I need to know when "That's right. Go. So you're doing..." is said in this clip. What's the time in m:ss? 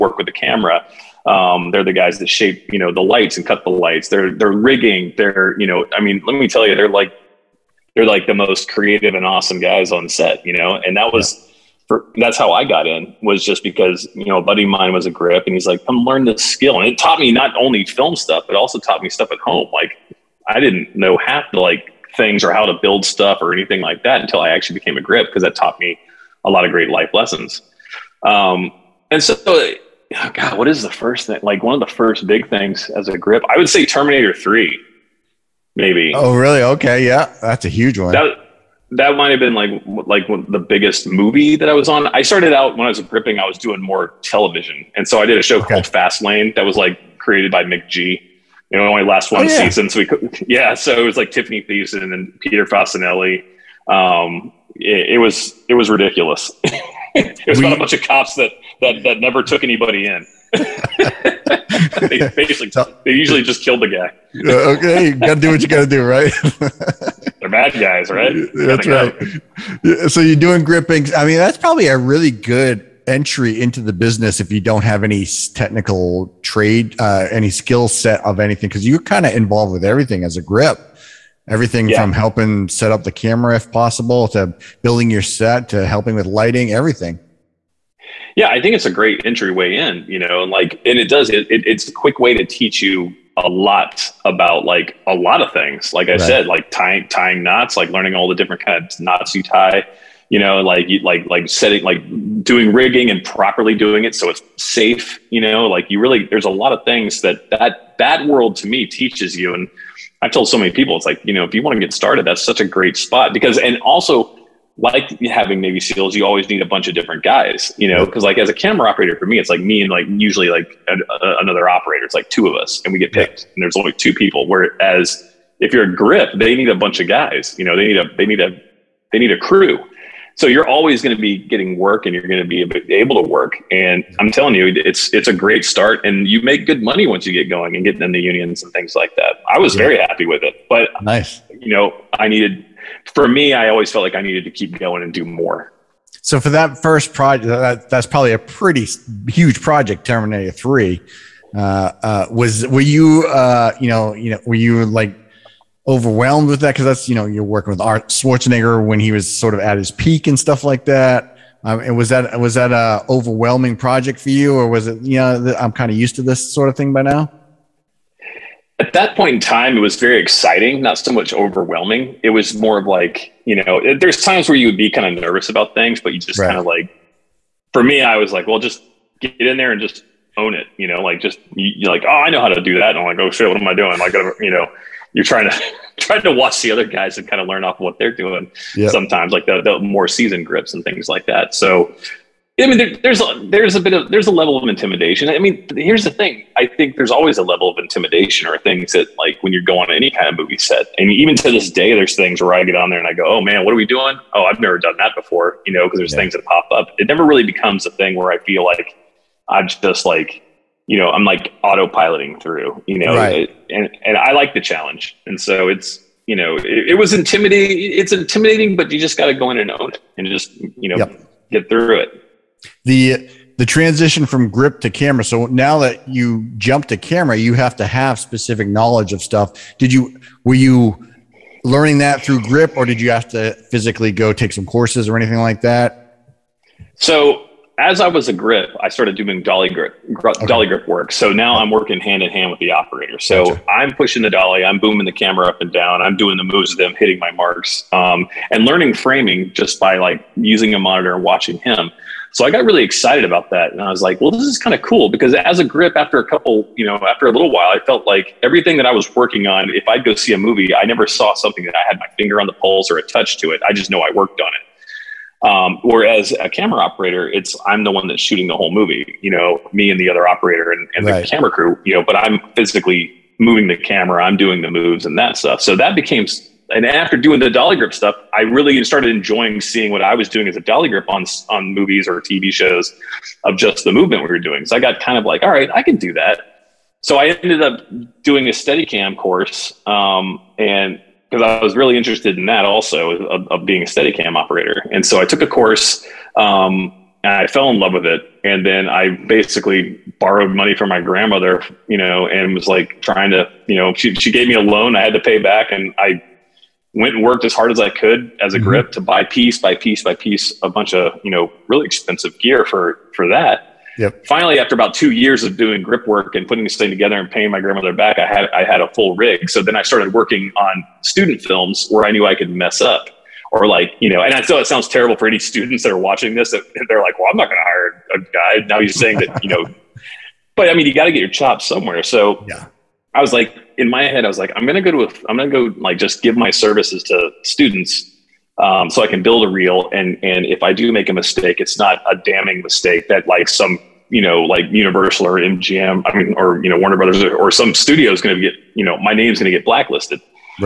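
1:08.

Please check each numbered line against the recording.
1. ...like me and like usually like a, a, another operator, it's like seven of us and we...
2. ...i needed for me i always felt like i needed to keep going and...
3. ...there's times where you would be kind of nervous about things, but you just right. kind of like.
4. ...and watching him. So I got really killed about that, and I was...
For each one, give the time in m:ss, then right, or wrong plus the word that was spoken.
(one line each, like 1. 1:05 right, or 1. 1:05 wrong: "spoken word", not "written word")
1. 1:59 wrong: "two", not "seven"
2. 2:22 right
3. 2:53 right
4. 4:11 wrong: "excited", not "killed".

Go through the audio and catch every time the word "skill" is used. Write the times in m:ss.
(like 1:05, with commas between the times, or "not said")
0:16, 1:17.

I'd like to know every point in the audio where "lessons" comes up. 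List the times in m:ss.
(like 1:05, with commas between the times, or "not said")
0:27.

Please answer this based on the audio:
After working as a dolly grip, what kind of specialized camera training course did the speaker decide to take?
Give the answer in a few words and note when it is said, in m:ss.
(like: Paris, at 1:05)
Steadicam course, at 4:48.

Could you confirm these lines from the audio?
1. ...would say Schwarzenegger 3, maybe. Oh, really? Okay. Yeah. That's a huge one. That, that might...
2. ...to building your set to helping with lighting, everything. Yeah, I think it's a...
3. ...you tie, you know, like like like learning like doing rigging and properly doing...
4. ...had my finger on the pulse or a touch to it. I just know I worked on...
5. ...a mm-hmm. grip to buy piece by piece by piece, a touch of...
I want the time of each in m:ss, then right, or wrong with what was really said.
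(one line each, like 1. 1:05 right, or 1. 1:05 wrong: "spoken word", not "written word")
1. 0:33 wrong: "Terminator", not "Schwarzenegger"
2. 1:24 right
3. 1:39 wrong: "setting", not "learning"
4. 4:21 right
5. 5:08 wrong: "bunch", not "touch".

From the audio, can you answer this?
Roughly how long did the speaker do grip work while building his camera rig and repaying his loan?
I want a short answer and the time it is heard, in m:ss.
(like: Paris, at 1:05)
2 years, at 5:14.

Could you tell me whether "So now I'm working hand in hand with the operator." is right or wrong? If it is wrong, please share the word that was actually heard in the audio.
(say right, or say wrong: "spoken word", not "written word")
right.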